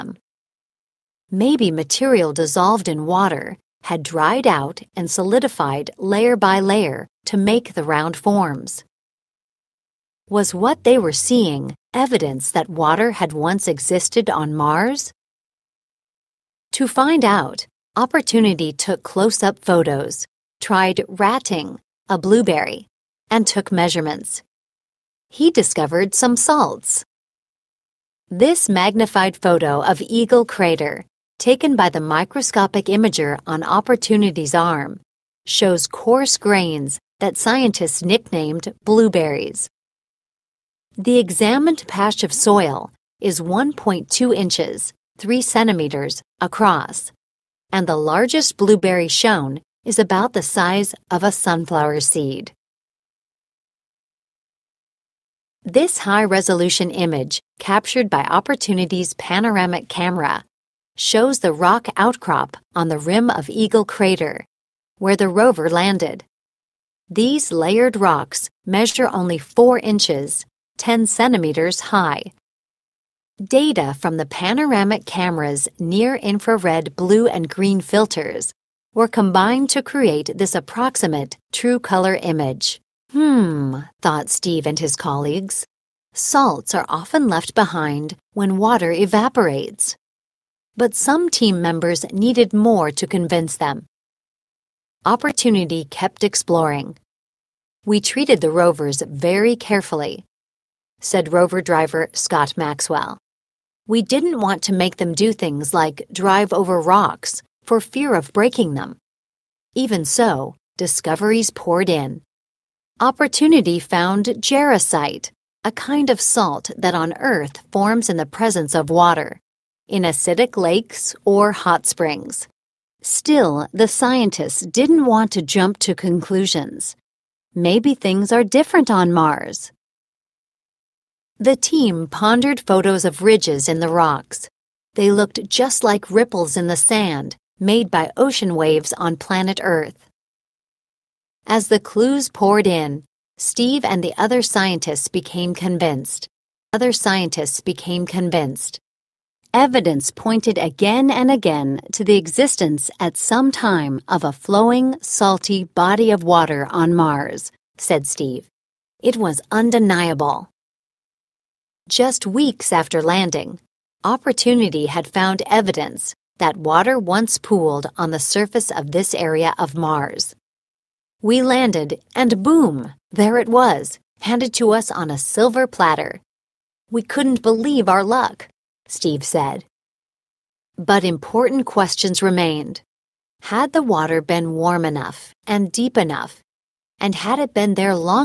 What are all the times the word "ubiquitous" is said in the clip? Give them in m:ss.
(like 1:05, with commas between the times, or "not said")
not said.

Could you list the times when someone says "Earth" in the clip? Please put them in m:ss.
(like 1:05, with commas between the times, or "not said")
1:57, 2:19.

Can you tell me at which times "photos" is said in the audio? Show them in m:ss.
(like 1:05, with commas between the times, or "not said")
0:19, 0:29, 2:12.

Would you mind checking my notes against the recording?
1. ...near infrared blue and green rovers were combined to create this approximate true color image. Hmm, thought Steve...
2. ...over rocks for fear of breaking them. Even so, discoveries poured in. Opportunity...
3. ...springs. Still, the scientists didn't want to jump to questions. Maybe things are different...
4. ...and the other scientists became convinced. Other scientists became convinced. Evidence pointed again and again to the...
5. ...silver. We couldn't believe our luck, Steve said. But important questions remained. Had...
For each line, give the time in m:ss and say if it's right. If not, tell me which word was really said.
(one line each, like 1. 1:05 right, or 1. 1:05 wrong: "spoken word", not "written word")
1. 1:15 wrong: "filters", not "rovers"
2. 1:46 right
3. 2:01 wrong: "conclusions", not "questions"
4. 2:23 right
5. 2:55 wrong: "platter", not "silver".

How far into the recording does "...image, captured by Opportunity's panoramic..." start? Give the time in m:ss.
0:56.